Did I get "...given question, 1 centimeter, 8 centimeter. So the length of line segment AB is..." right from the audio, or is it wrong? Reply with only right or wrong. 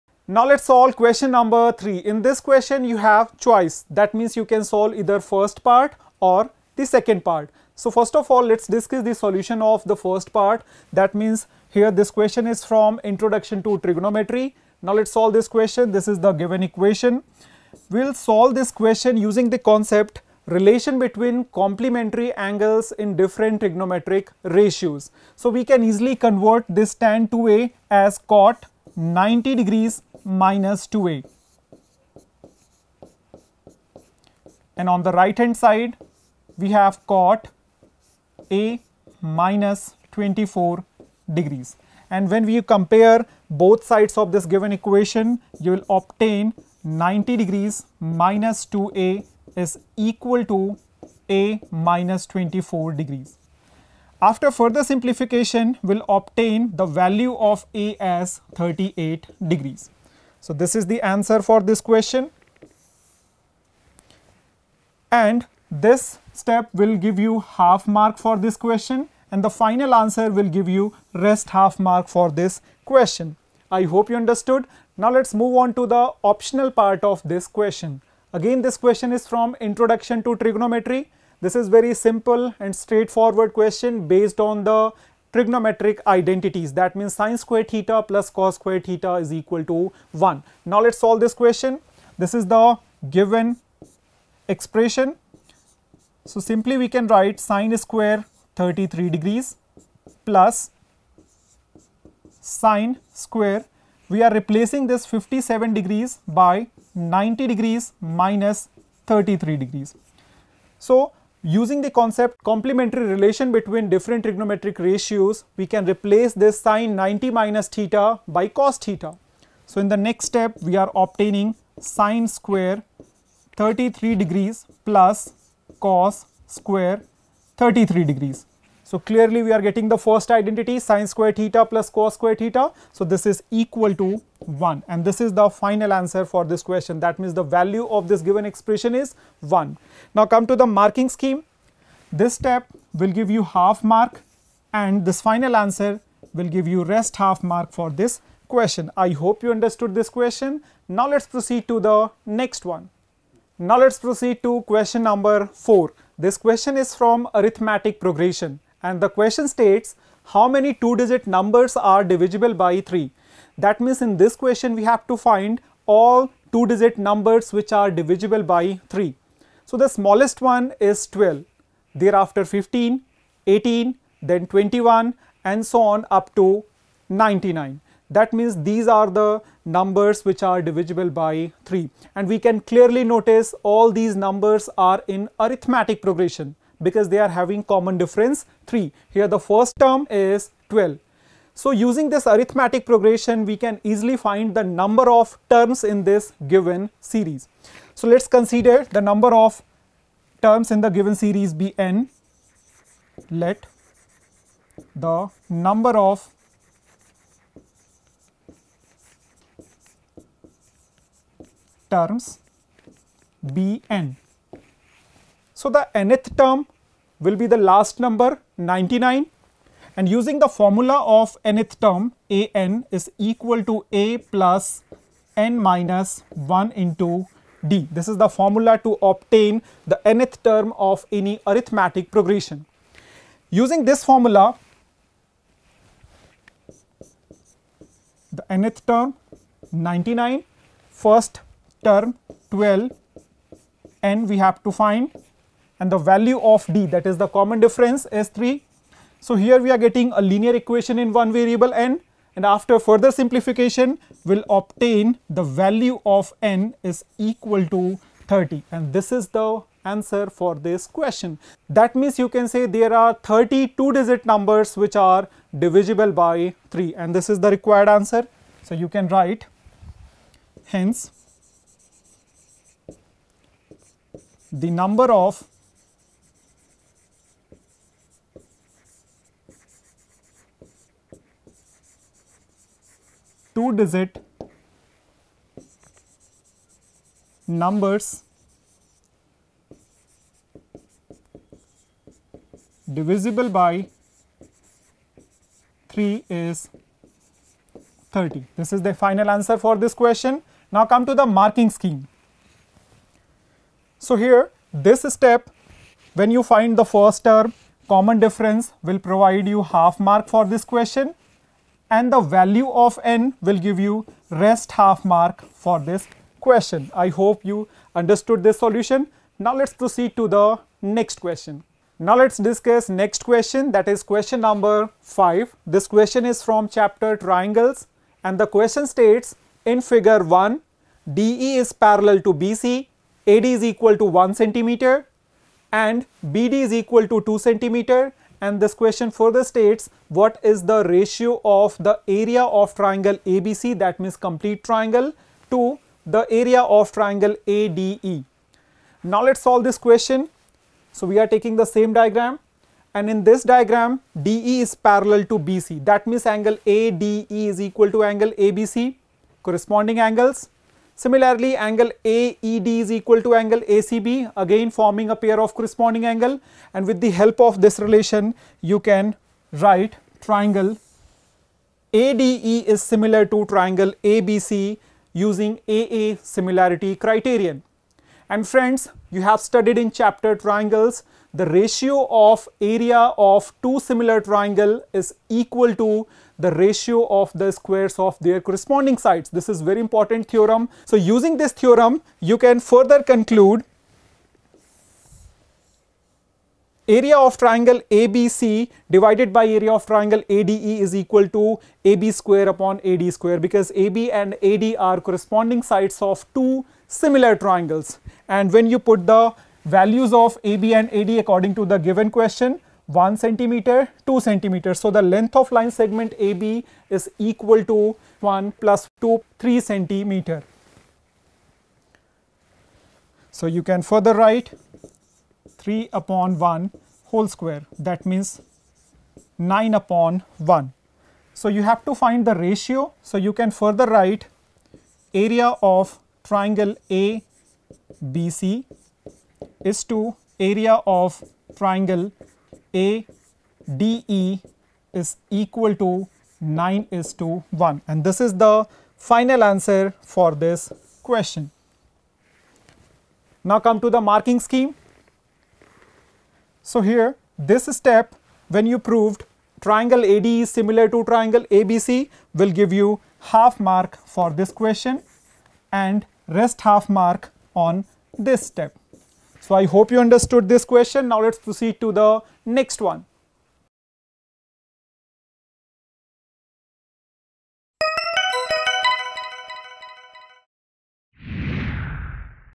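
wrong.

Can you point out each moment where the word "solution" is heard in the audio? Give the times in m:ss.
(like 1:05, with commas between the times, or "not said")
0:09, 5:18.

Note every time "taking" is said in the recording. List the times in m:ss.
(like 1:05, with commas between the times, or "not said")
5:51.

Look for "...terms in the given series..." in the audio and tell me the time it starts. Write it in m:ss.
3:20.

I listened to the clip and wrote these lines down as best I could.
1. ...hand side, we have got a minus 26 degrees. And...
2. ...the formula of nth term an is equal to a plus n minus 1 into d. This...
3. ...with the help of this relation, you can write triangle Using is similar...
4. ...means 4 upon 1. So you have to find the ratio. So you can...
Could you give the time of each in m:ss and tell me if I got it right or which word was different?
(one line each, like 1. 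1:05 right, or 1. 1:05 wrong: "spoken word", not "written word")
1. 0:35 wrong: "24", not "26"
2. 3:40 right
3. 6:06 wrong: "ADE", not "Using"
4. 7:08 wrong: "9", not "4".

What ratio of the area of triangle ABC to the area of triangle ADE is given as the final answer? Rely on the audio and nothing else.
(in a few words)
9:1.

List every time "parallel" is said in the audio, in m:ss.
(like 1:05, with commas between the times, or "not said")
5:31, 5:54.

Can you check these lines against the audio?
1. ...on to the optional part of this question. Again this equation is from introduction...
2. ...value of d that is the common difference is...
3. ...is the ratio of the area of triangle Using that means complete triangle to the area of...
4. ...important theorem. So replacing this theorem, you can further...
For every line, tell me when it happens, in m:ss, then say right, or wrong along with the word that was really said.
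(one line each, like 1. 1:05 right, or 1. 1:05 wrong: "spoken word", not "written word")
1. 1:15 wrong: "question", not "equation"
2. 4:06 right
3. 5:40 wrong: "ABC", not "Using"
4. 6:29 wrong: "using", not "replacing".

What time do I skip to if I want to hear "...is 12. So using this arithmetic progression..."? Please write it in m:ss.
3:10.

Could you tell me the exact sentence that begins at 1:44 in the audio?
We are replacing this 57 degrees by 90 degrees minus 33 degrees.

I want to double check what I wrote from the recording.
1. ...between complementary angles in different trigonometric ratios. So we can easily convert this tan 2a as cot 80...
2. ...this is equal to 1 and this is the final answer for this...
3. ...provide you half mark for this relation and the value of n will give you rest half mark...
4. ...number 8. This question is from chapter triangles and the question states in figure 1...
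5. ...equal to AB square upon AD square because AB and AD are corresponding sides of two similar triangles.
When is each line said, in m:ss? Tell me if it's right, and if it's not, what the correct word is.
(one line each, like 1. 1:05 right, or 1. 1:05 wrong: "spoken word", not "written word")
1. 0:20 wrong: "90", not "80"
2. 2:13 right
3. 5:09 wrong: "question", not "relation"
4. 5:24 wrong: "5", not "8"
5. 6:40 right.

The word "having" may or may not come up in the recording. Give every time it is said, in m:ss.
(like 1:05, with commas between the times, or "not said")
3:07.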